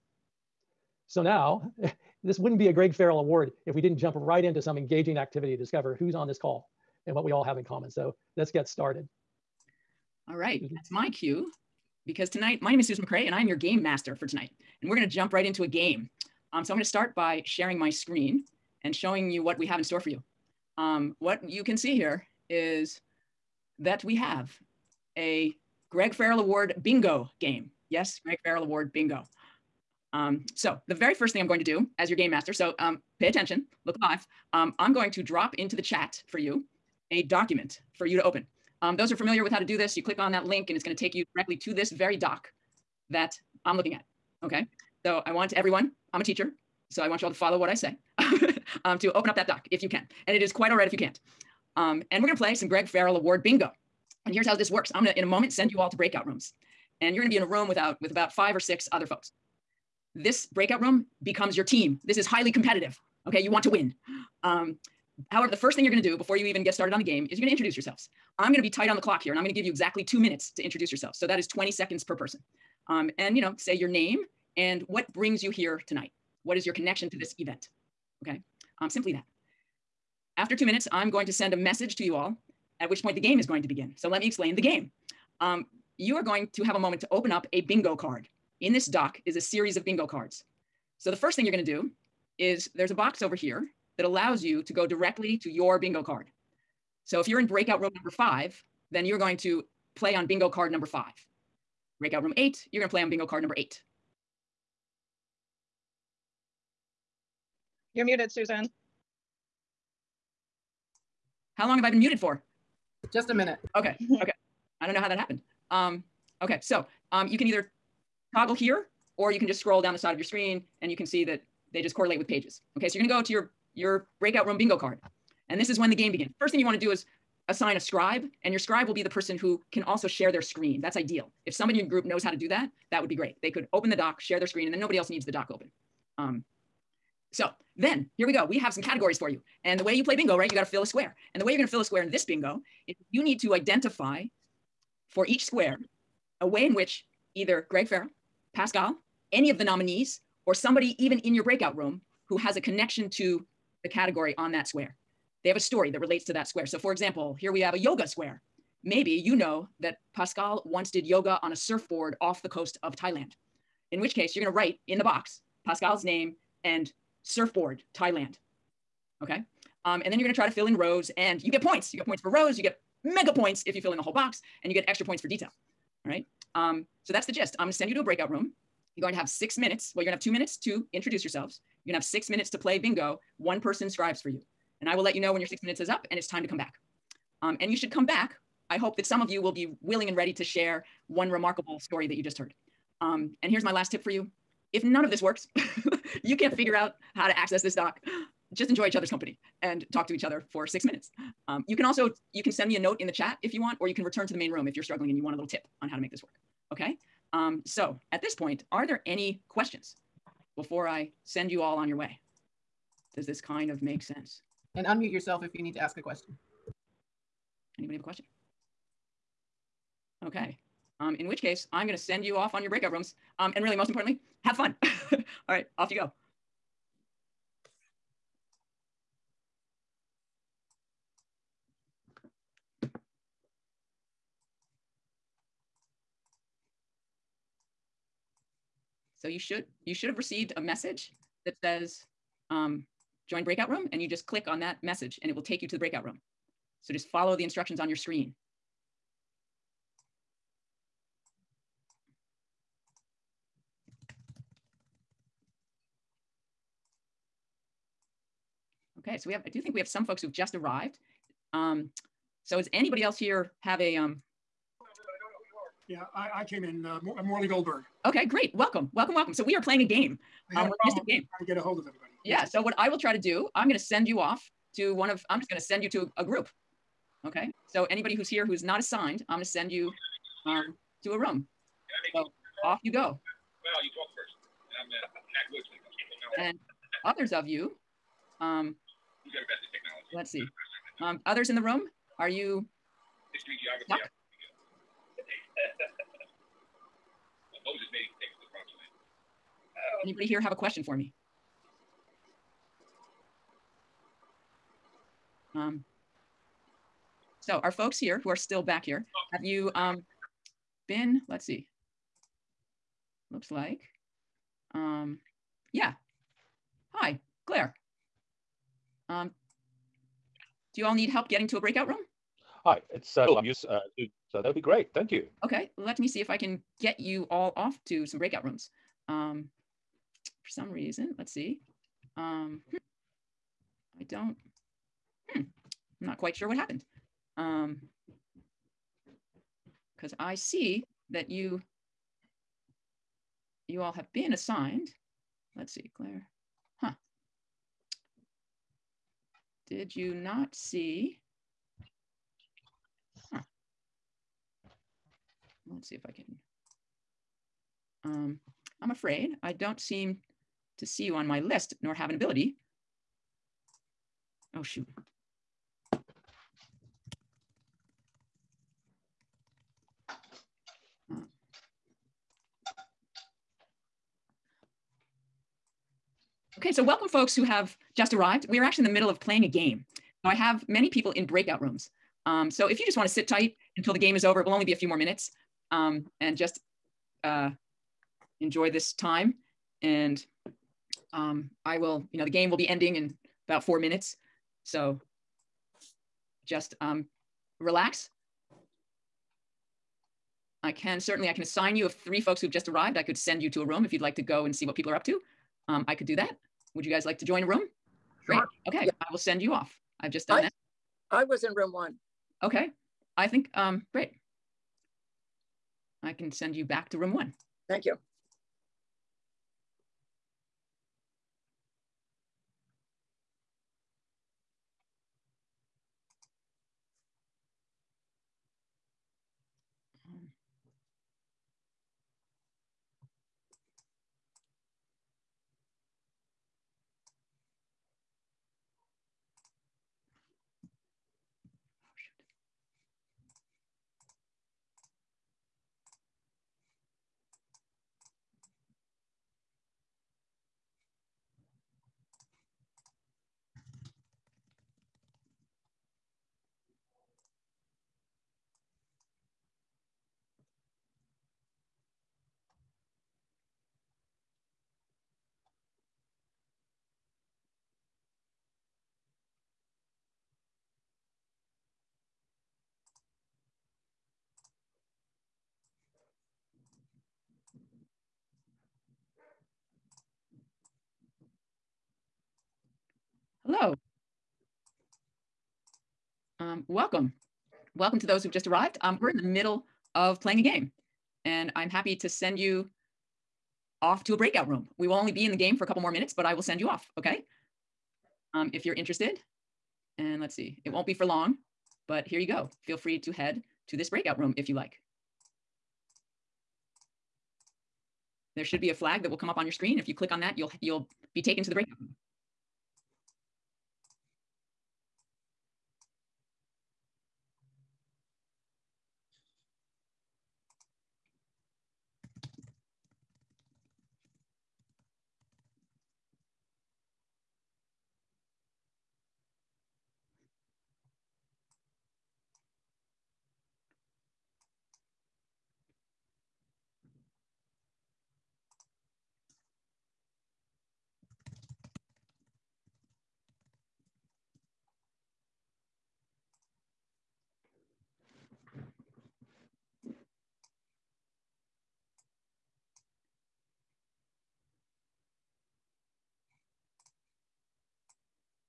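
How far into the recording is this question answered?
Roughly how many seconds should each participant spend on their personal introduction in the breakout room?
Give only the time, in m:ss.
1:11.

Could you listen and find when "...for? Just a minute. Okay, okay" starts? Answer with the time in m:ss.
1:52.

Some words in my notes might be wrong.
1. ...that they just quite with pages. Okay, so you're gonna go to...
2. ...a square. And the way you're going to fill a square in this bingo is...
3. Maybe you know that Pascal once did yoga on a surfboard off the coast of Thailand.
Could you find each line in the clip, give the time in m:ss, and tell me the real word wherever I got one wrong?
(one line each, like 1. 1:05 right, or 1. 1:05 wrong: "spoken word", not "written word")
1. 2:01 wrong: "correlate", not "quite"
2. 2:20 right
3. 2:38 right.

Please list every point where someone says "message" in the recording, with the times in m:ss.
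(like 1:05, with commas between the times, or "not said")
1:21, 4:00, 4:04.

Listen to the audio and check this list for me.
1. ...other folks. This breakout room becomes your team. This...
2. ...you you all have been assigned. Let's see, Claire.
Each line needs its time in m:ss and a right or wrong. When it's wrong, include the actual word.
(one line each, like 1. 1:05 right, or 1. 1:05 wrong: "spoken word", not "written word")
1. 0:58 right
2. 5:41 right.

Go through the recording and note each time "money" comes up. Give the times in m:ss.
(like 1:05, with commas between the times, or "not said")
not said.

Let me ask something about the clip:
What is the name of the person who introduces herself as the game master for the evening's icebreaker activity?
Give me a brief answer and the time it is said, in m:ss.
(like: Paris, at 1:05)
Susan McCrae, at 0:12.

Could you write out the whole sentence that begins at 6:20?
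Now, I have many people in breakout rooms.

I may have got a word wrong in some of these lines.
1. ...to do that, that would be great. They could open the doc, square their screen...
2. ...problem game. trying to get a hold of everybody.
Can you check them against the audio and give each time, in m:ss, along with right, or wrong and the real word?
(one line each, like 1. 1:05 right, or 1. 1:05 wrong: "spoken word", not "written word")
1. 2:12 wrong: "share", not "square"
2. 4:30 right.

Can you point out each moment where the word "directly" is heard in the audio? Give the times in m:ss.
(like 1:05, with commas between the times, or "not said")
0:41, 1:34.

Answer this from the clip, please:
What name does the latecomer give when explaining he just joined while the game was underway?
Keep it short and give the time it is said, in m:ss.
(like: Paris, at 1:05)
Morley Goldberg, at 4:27.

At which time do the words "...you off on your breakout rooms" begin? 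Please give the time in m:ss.
3:42.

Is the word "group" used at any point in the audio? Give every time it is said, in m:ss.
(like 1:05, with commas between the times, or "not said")
2:11, 4:36.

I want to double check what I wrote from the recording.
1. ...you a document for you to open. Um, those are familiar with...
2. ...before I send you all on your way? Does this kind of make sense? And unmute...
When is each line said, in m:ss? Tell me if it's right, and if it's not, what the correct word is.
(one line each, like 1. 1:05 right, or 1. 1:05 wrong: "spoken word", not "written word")
1. 0:36 right
2. 3:30 right.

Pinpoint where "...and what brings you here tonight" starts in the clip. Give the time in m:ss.
1:14.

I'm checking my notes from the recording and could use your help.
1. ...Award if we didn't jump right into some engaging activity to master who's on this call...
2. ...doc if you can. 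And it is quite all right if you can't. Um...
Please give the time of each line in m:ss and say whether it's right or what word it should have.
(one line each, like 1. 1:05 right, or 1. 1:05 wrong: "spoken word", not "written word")
1. 0:03 wrong: "discover", not "master"
2. 0:49 right.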